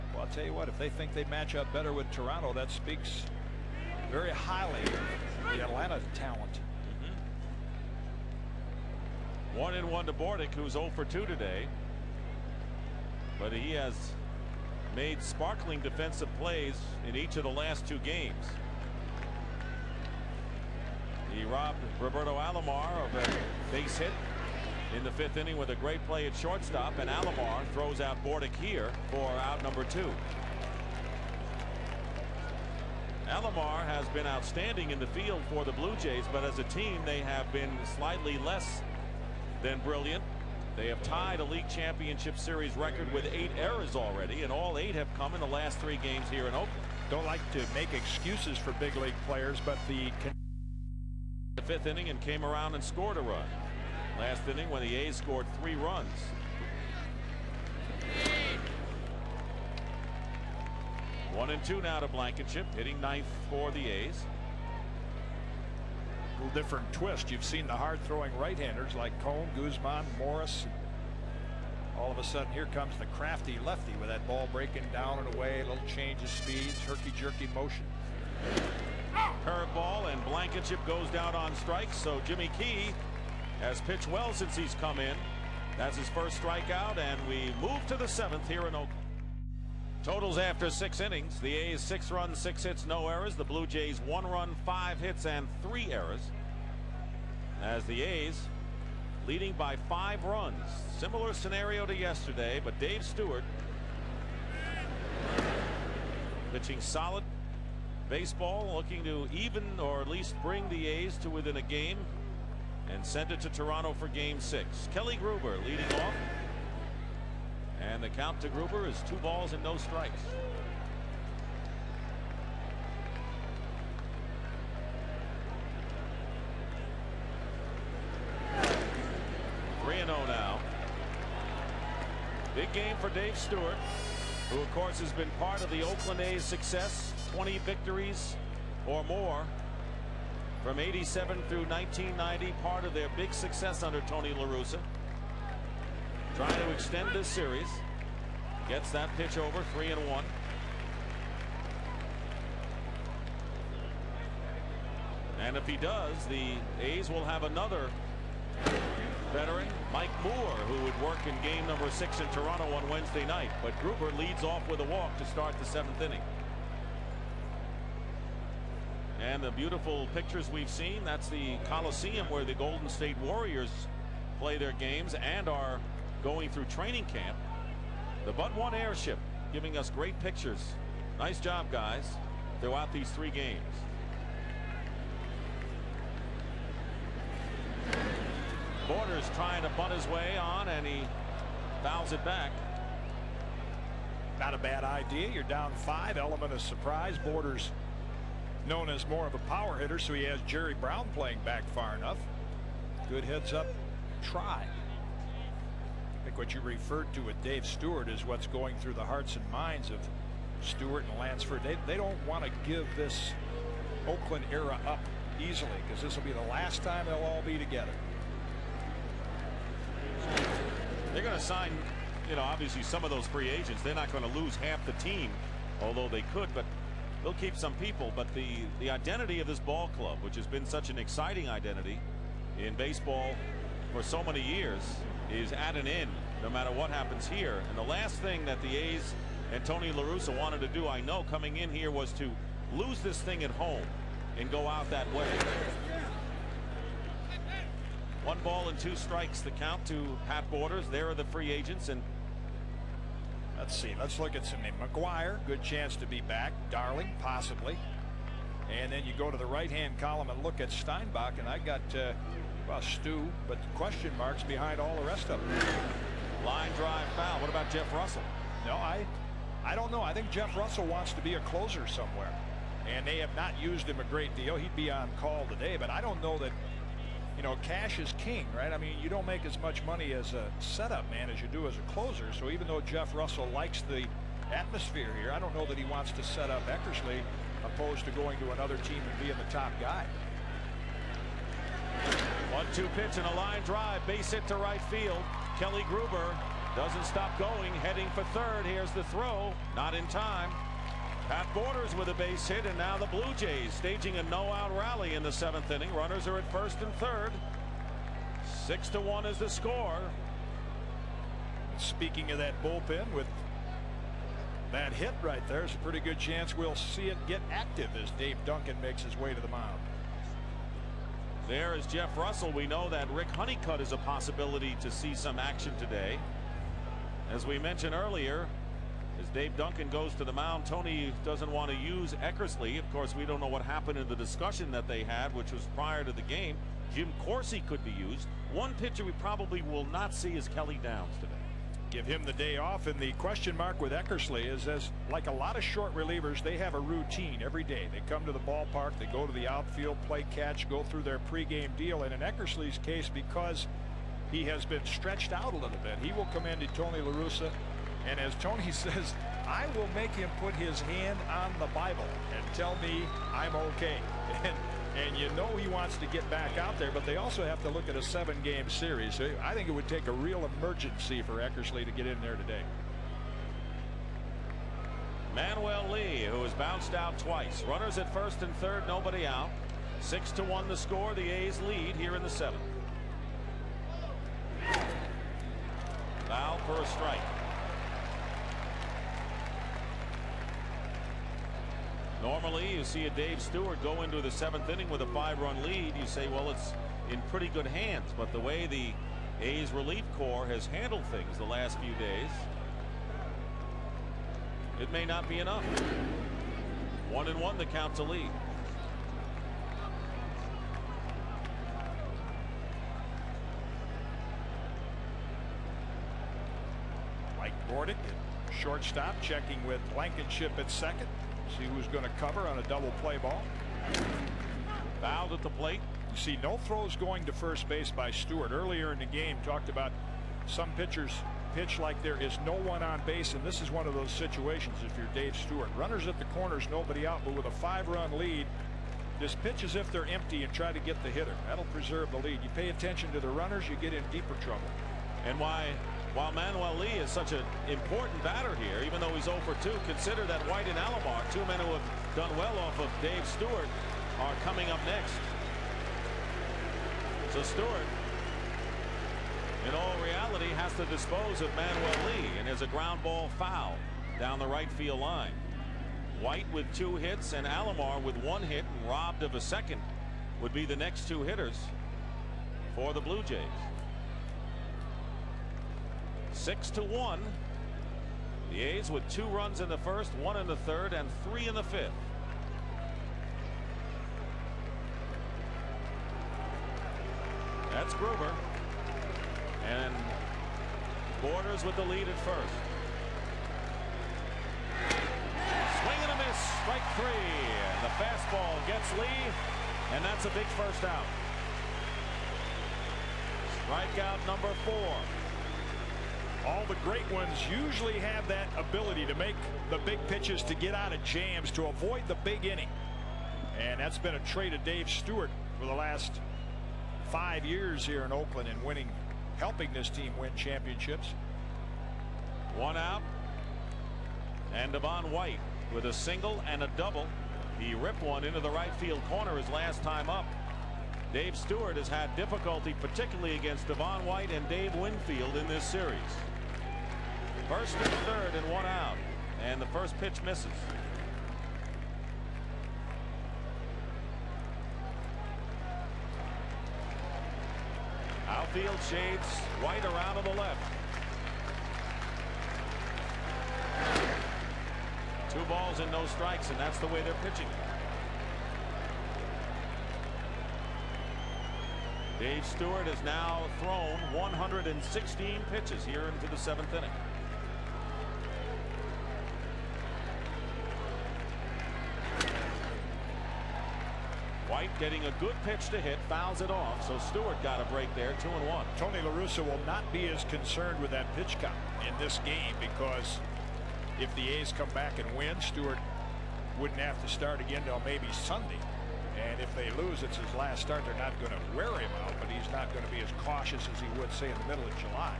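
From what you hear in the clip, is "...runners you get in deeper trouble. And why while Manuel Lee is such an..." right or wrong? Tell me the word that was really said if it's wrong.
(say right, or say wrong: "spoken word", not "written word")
right.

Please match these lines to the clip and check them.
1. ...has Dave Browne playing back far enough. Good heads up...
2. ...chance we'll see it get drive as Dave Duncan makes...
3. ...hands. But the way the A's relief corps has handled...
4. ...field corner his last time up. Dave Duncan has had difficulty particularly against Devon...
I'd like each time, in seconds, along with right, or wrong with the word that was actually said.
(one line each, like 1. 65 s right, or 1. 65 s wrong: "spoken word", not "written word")
1. 200 s wrong: "Jerry", not "Dave"
2. 316 s wrong: "active", not "drive"
3. 397 s right
4. 528 s wrong: "Stewart", not "Duncan".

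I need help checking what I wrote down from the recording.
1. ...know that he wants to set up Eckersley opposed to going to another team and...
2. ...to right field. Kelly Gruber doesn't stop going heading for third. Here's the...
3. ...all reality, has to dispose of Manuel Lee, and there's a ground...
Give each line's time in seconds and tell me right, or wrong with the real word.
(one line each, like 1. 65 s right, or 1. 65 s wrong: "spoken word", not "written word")
1. 285 s right
2. 294 s right
3. 459 s right.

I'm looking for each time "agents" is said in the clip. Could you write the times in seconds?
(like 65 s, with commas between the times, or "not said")
223 s, 251 s.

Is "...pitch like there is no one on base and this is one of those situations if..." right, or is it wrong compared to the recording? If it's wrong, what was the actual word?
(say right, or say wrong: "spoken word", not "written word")
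right.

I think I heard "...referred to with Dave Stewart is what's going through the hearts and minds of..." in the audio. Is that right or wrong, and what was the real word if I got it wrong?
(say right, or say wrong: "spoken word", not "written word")
right.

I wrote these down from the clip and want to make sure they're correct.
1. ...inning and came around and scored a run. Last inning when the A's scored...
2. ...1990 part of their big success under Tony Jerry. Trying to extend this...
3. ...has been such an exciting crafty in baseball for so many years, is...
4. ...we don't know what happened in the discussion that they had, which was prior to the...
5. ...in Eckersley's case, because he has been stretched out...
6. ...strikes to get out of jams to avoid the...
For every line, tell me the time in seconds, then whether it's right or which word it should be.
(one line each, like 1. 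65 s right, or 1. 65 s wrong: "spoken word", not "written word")
1. 51 s right
2. 141 s wrong: "LaRussa", not "Jerry"
3. 230 s wrong: "identity", not "crafty"
4. 333 s right
5. 352 s right
6. 510 s wrong: "pitches", not "strikes".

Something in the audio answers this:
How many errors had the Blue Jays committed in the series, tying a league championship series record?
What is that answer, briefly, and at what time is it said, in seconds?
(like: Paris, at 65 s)
8, at 43 s.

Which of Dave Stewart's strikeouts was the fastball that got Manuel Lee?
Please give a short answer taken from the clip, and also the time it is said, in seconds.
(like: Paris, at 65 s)
4, at 503 s.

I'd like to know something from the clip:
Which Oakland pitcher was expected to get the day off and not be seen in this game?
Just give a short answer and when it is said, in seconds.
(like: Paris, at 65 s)
Kelly Downs, at 340 s.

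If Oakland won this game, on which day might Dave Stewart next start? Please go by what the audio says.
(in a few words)
Sunday.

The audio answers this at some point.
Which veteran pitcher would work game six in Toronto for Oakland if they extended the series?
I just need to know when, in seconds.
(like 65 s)
159 s.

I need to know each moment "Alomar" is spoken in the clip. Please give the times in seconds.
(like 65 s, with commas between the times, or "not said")
22 s, 27 s, 33 s, 450 s, 467 s.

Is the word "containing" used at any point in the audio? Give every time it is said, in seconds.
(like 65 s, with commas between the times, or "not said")
not said.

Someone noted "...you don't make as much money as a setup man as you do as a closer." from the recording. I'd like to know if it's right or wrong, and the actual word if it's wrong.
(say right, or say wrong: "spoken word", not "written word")
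right.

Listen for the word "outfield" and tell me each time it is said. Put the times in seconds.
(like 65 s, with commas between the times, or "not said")
349 s, 548 s.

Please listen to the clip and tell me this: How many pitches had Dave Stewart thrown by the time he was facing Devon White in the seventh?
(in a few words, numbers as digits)
116.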